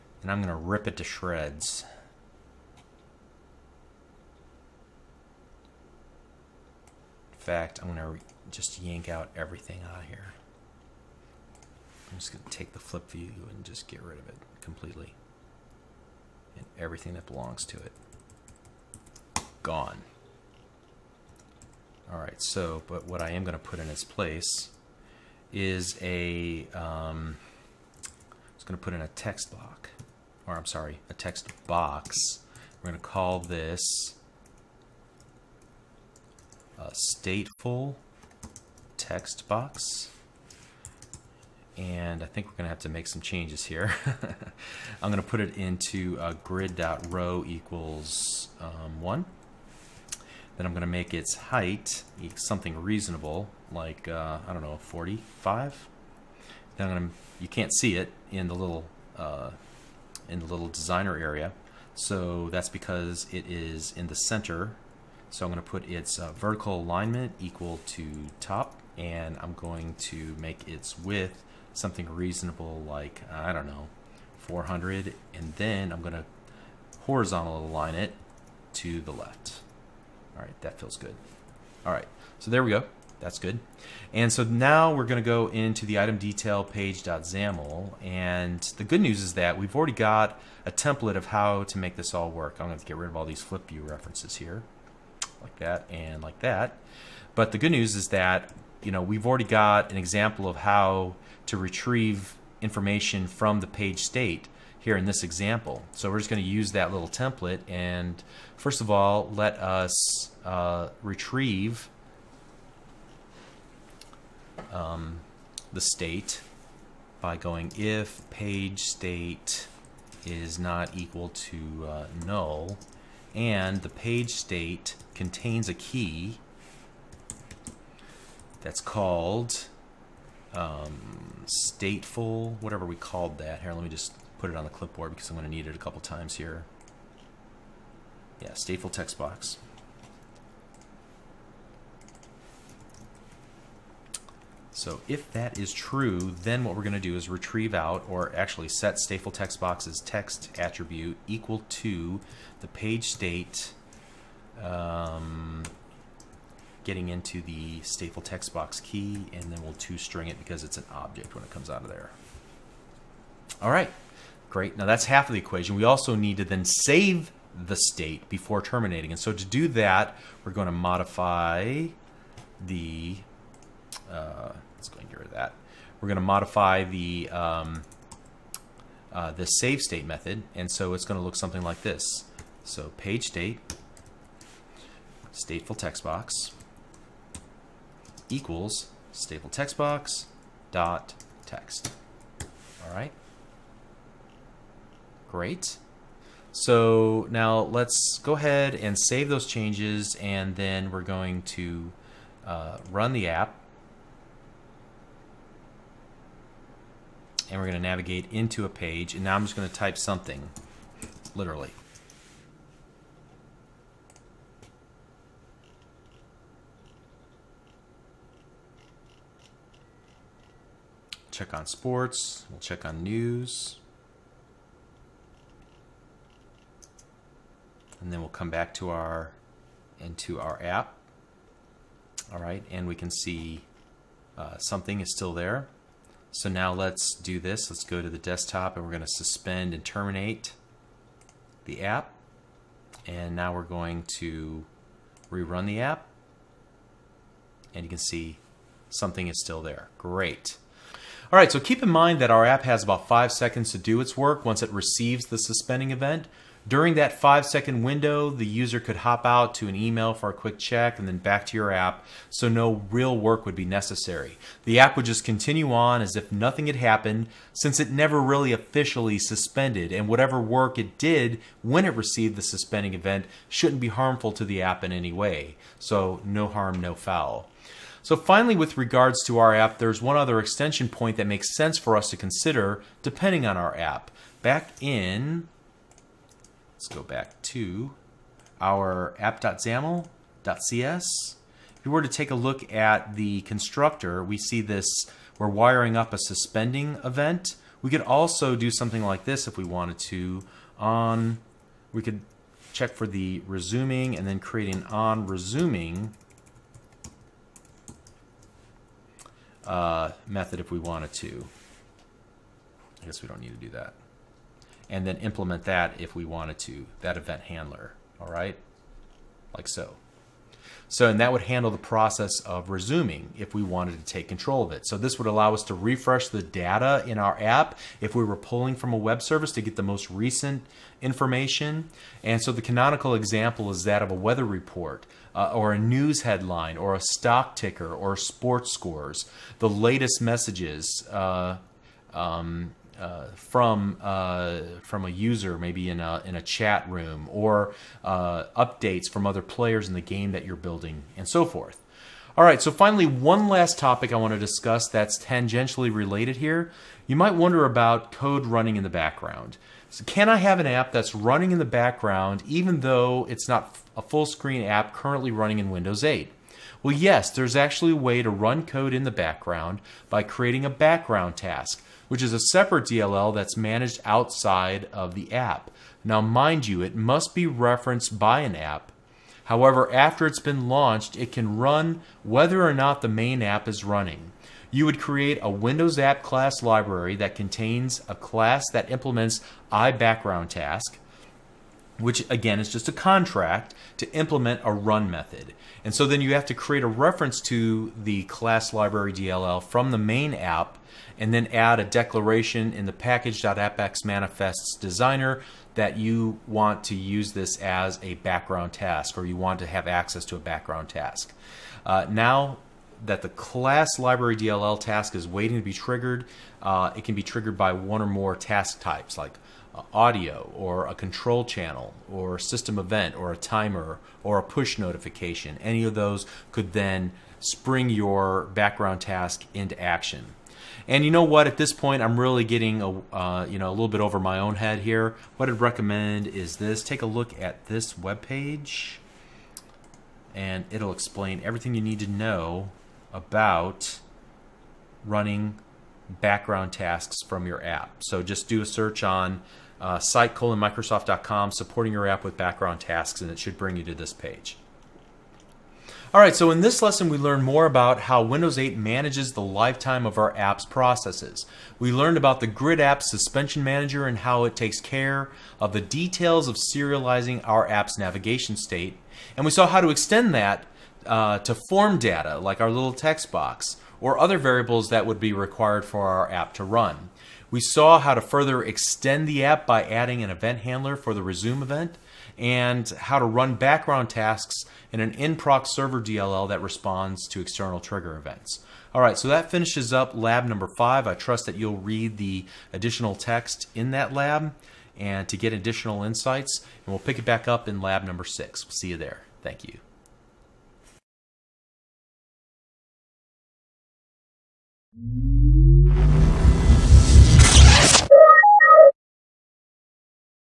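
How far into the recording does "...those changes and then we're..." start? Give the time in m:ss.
3:19.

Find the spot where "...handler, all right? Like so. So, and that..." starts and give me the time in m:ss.
5:17.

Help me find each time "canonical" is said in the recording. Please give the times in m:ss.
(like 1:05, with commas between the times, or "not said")
5:32.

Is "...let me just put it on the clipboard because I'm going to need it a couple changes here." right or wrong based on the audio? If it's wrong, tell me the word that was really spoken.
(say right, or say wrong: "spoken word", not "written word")
wrong: "times", not "changes".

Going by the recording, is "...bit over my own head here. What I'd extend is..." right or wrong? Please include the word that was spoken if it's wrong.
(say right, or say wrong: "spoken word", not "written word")
wrong: "recommend", not "extend".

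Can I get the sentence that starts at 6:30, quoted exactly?
task which again is just a contract to implement a run method.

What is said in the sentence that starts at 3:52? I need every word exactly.
All right, and we can see uh, something is still there.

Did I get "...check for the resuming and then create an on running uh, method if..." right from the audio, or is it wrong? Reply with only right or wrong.
wrong.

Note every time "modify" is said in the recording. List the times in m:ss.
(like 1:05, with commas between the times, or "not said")
2:50, 2:56.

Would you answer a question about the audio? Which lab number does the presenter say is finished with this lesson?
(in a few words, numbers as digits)
5.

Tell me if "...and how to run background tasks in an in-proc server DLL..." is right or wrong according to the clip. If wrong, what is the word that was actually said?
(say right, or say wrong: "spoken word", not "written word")
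right.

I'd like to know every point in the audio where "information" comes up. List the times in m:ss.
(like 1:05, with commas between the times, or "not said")
1:42, 5:31.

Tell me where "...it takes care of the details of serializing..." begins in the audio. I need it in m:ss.
7:44.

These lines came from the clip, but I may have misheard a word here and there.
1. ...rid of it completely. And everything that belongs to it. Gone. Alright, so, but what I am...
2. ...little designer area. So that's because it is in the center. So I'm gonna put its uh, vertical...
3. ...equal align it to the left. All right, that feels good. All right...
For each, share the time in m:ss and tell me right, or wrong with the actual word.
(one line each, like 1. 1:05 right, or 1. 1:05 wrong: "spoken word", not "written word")
1. 0:14 right
2. 1:00 right
3. 1:17 wrong: "horizontal", not "equal".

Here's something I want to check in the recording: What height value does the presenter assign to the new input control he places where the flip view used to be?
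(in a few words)
45.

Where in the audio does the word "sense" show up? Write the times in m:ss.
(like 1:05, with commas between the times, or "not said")
4:41.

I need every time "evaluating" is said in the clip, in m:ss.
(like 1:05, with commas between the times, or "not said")
not said.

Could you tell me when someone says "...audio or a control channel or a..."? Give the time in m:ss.
6:59.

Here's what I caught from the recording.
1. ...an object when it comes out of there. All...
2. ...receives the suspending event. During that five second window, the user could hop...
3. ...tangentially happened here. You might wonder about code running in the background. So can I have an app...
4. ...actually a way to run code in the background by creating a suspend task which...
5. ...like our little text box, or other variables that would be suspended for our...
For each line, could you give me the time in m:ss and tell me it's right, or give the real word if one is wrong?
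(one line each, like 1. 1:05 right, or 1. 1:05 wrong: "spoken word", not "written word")
1. 2:40 right
2. 4:14 right
3. 5:55 wrong: "related", not "happened"
4. 6:07 wrong: "background", not "suspend"
5. 7:52 wrong: "required", not "suspended".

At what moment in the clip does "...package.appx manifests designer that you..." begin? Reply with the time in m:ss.
6:42.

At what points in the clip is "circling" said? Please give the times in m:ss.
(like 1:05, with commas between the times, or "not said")
not said.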